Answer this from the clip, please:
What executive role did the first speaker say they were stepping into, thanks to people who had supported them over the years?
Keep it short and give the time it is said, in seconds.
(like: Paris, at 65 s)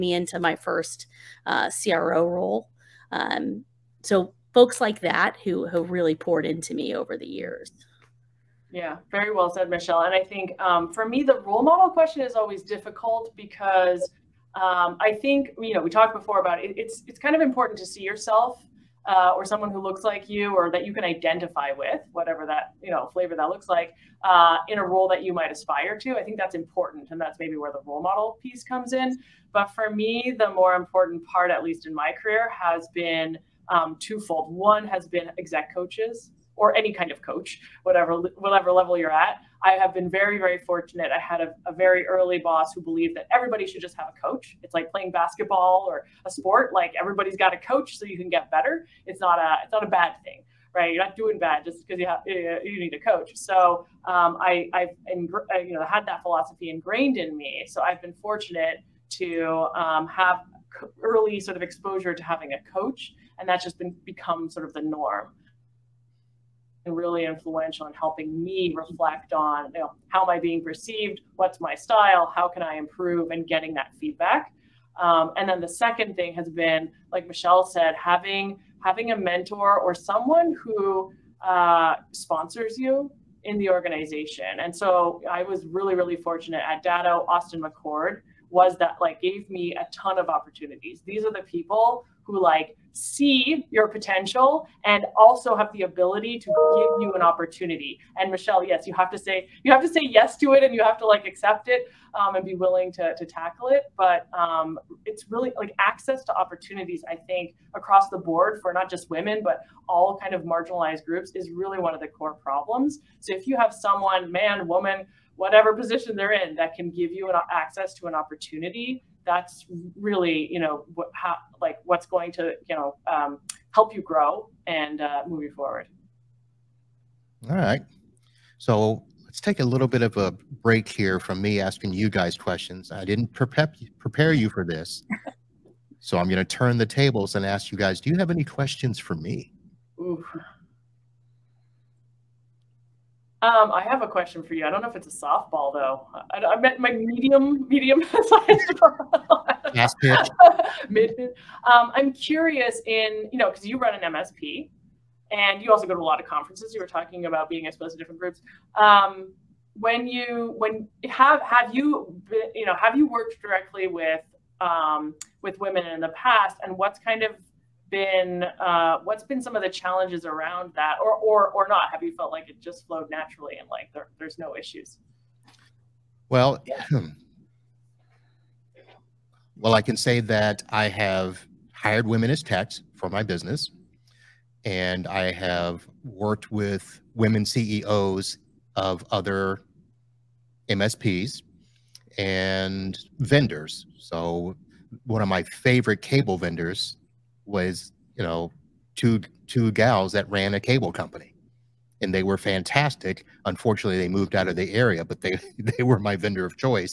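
CRO, at 1 s.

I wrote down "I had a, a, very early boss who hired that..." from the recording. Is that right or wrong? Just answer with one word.
wrong.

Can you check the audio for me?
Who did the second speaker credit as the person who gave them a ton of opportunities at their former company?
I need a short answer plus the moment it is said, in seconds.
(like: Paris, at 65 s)
Austin McChord, at 87 s.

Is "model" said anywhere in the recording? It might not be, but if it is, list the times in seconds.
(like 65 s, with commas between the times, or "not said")
11 s, 28 s.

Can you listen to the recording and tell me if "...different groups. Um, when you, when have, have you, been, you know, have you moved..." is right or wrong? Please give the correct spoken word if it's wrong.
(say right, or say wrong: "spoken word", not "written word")
wrong: "worked", not "moved".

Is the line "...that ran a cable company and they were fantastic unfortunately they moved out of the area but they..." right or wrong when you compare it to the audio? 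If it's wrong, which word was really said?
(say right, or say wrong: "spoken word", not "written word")
right.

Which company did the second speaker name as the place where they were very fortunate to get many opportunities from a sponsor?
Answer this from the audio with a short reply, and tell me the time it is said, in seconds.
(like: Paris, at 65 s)
Datto, at 86 s.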